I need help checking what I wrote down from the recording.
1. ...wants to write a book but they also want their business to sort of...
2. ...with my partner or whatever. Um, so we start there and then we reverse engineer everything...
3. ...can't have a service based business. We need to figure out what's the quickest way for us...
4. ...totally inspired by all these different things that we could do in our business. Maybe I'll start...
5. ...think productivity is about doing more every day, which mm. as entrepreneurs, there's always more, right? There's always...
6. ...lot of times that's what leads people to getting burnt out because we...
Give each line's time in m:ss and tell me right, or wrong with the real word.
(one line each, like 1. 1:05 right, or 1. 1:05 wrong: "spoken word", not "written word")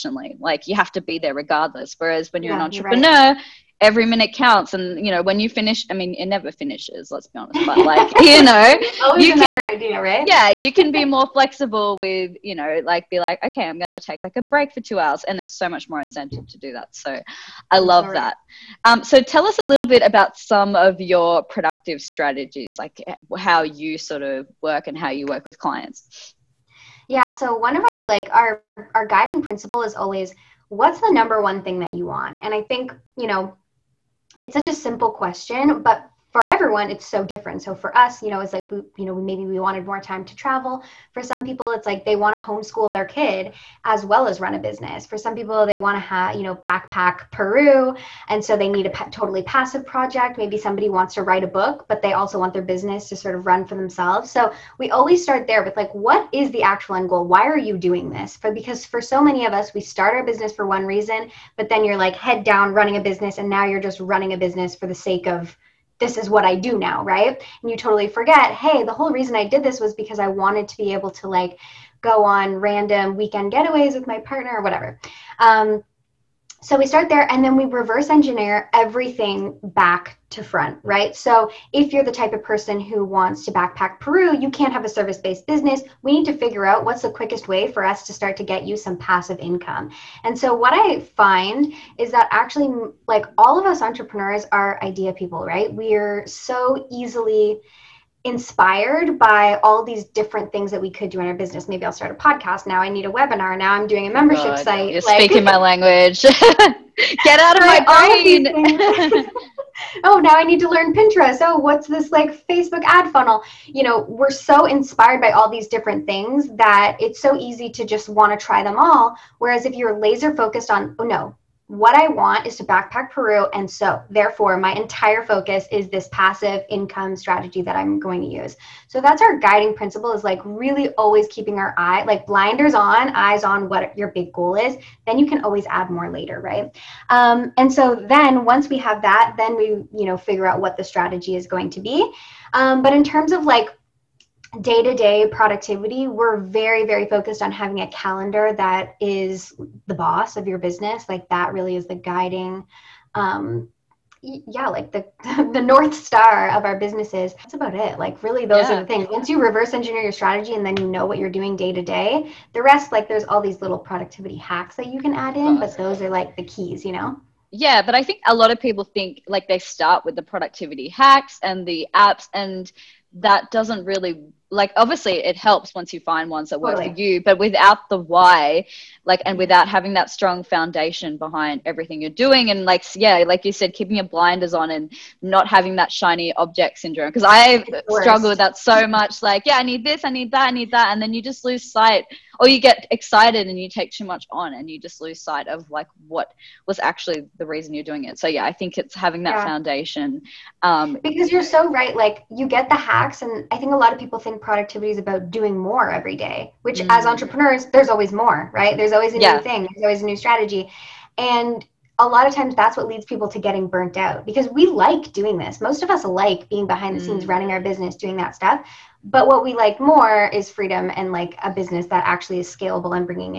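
1. 0:50 right
2. 1:13 right
3. 1:24 right
4. 1:36 wrong: "easily", not "totally"
5. 3:24 right
6. 3:32 right.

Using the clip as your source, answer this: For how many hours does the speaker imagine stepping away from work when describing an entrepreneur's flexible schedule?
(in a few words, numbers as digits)
2.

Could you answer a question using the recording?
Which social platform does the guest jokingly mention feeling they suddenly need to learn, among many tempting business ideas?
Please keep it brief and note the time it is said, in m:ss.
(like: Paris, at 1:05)
Pinterest, at 1:50.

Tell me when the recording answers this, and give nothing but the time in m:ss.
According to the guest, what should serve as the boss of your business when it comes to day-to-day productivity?
2:27.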